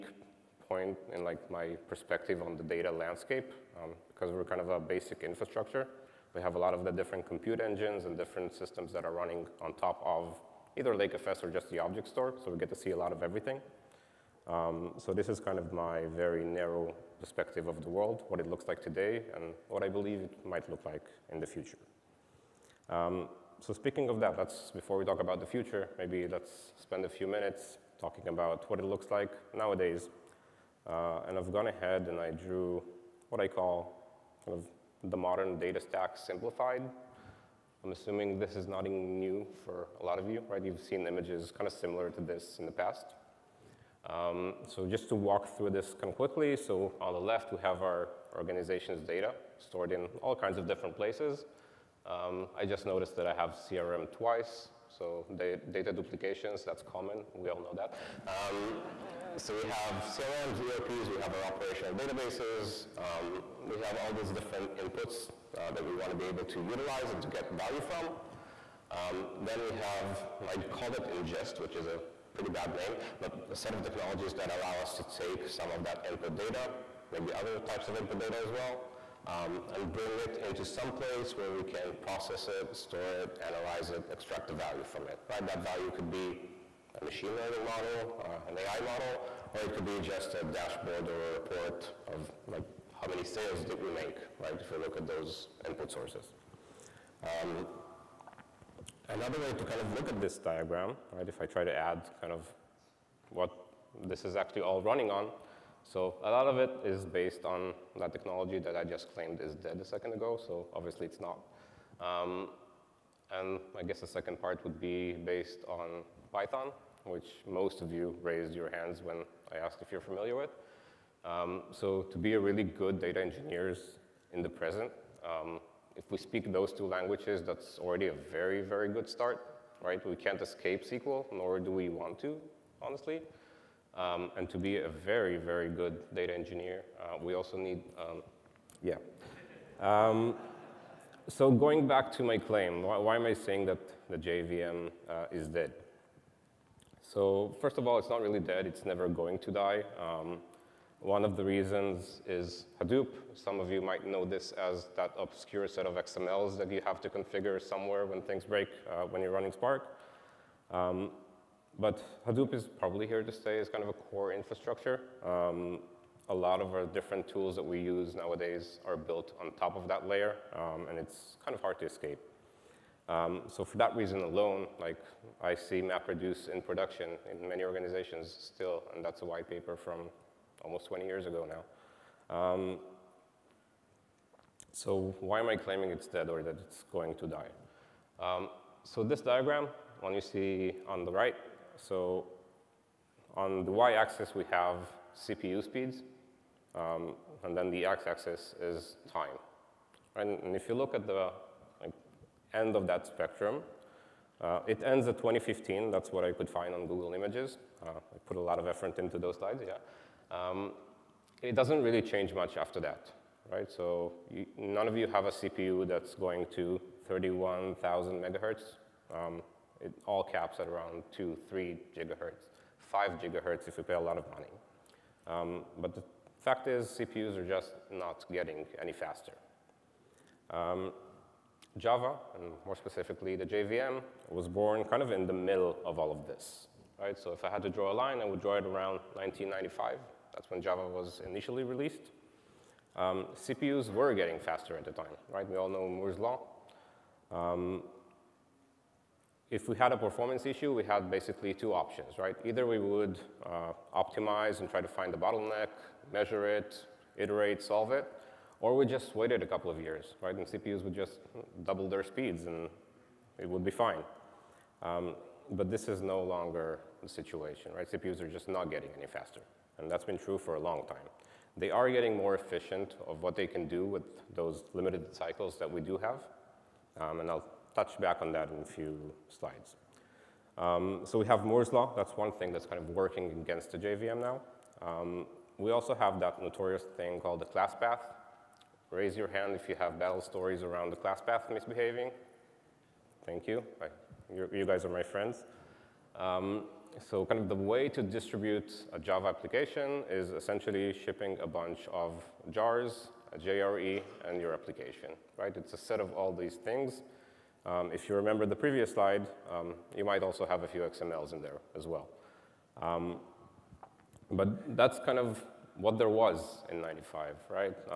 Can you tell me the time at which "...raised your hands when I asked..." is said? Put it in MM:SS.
01:58.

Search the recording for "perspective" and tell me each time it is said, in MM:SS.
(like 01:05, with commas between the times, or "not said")
00:01, 00:17.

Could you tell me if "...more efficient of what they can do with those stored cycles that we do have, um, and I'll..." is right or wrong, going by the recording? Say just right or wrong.
wrong.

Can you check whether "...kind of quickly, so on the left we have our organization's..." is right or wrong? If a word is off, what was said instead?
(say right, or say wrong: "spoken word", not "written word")
right.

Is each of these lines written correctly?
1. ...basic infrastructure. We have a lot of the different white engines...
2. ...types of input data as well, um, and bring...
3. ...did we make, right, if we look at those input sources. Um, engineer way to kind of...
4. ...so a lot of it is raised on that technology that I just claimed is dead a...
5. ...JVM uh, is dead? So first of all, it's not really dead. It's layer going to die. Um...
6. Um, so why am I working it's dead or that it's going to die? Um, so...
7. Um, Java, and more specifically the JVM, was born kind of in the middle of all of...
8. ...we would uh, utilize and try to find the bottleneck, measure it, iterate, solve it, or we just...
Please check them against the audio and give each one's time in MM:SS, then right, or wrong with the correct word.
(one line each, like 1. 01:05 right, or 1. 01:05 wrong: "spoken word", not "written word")
1. 00:04 wrong: "compute", not "white"
2. 01:17 right
3. 01:33 wrong: "another", not "engineer"
4. 01:45 wrong: "based", not "raised"
5. 02:24 wrong: "never", not "layer"
6. 03:02 wrong: "claiming", not "working"
7. 03:50 right
8. 04:12 wrong: "optimize", not "utilize".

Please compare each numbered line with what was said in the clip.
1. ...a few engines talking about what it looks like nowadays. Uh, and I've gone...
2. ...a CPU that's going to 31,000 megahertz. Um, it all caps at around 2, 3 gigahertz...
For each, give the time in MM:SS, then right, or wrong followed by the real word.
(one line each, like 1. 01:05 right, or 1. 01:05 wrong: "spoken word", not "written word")
1. 00:27 wrong: "minutes", not "engines"
2. 03:35 right.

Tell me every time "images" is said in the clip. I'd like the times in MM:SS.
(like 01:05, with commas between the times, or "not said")
00:41, 03:27.